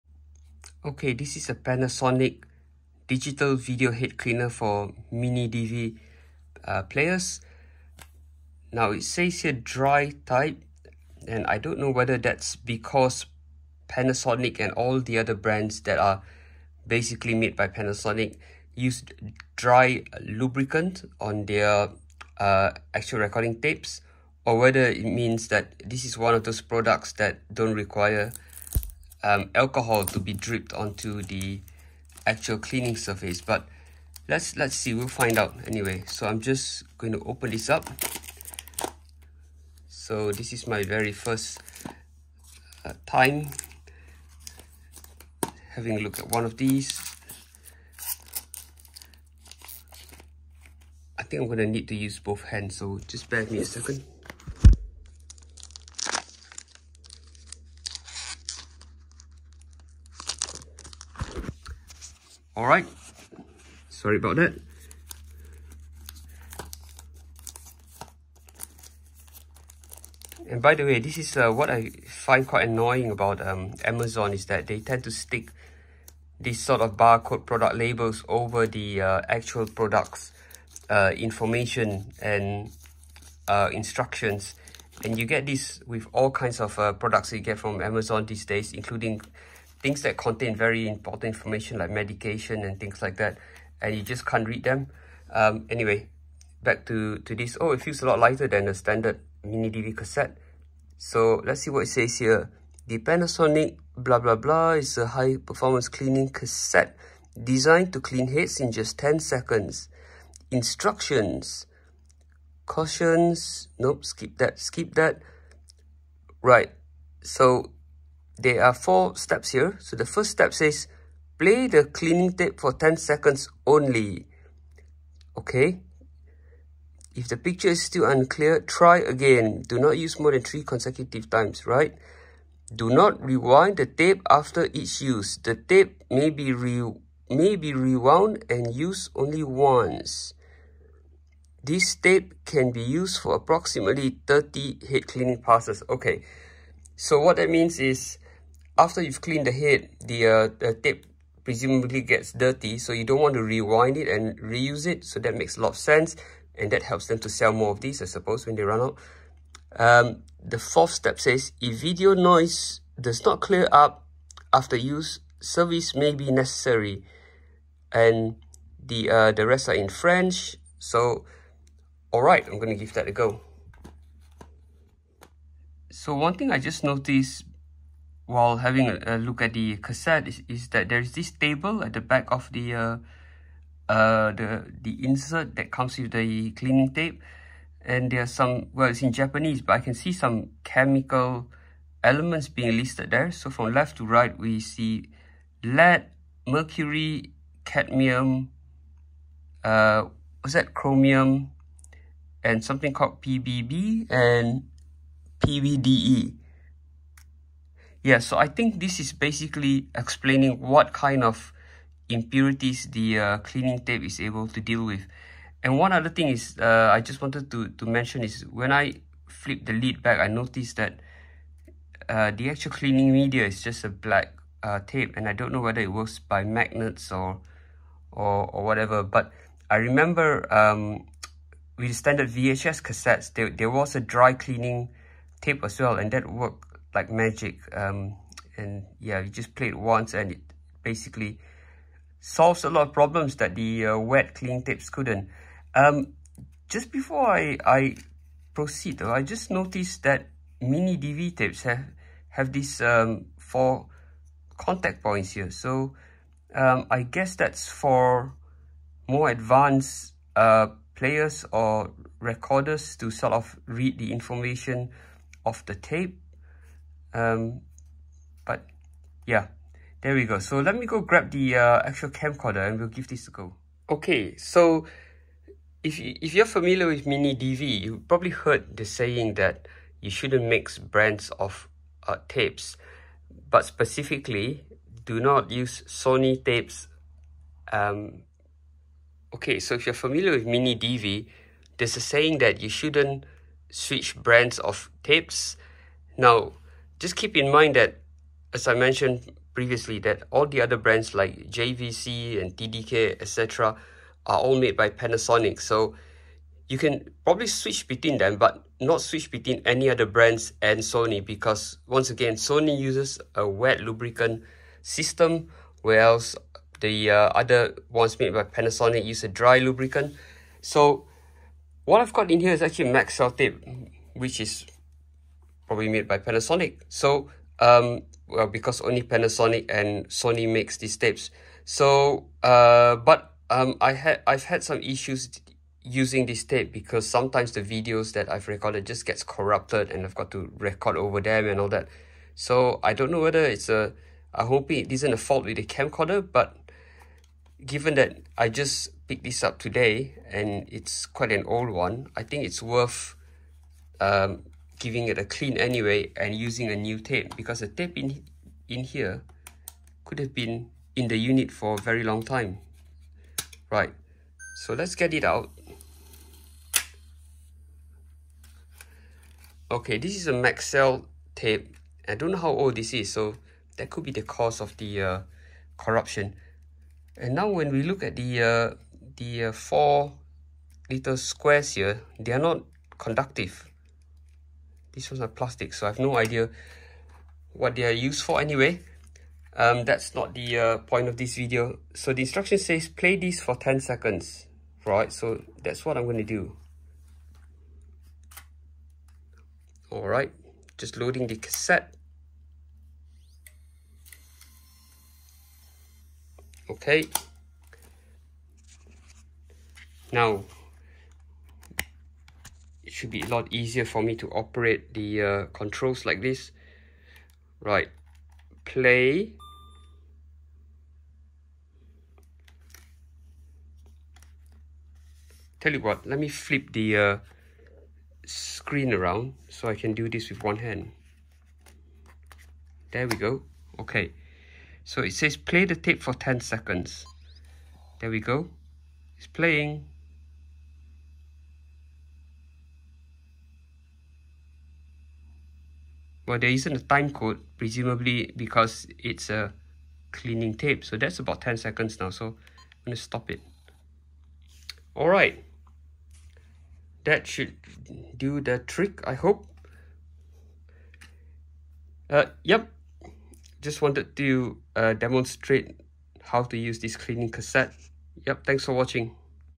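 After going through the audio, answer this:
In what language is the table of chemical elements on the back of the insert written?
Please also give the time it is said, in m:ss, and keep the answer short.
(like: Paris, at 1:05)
Japanese, at 3:09.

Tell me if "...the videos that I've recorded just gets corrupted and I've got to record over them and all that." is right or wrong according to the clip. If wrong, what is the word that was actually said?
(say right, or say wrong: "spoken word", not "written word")
right.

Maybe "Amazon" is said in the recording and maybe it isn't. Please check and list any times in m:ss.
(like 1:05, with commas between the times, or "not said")
1:13, 1:27.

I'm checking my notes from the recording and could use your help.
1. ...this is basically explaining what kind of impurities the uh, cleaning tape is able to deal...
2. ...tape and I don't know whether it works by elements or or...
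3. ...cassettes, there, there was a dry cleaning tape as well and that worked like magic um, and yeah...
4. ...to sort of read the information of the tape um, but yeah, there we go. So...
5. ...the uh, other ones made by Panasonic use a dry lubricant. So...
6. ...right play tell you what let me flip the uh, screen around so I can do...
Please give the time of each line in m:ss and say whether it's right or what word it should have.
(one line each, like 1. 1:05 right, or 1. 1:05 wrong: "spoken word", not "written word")
1. 3:28 right
2. 3:44 wrong: "magnets", not "elements"
3. 3:52 right
4. 4:22 right
5. 5:16 right
6. 6:57 right.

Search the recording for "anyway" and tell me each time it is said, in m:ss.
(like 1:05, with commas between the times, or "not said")
0:35, 1:35, 5:55, 6:28.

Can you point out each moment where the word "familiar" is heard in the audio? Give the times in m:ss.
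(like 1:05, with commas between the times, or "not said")
4:36, 4:49.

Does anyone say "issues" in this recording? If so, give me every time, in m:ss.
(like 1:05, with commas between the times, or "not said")
5:34.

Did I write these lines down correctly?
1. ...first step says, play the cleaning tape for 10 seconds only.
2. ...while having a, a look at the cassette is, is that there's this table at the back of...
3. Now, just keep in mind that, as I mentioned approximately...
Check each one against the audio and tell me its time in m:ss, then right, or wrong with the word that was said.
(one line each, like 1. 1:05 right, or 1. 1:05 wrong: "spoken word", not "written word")
1. 2:00 right
2. 2:58 right
3. 4:56 wrong: "previously", not "approximately".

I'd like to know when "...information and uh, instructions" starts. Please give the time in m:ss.
1:21.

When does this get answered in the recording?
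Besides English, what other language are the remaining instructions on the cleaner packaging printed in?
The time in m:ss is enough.
2:49.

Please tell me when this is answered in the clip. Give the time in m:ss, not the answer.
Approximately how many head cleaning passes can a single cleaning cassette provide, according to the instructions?
2:23.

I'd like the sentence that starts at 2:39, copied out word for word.
Um, the fourth step says, if video noise does not clear up after use, service may be necessary.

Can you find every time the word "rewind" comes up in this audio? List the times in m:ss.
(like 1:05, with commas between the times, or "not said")
2:13, 2:33.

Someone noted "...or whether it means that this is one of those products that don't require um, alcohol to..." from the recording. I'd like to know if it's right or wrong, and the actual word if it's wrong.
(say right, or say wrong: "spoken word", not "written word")
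right.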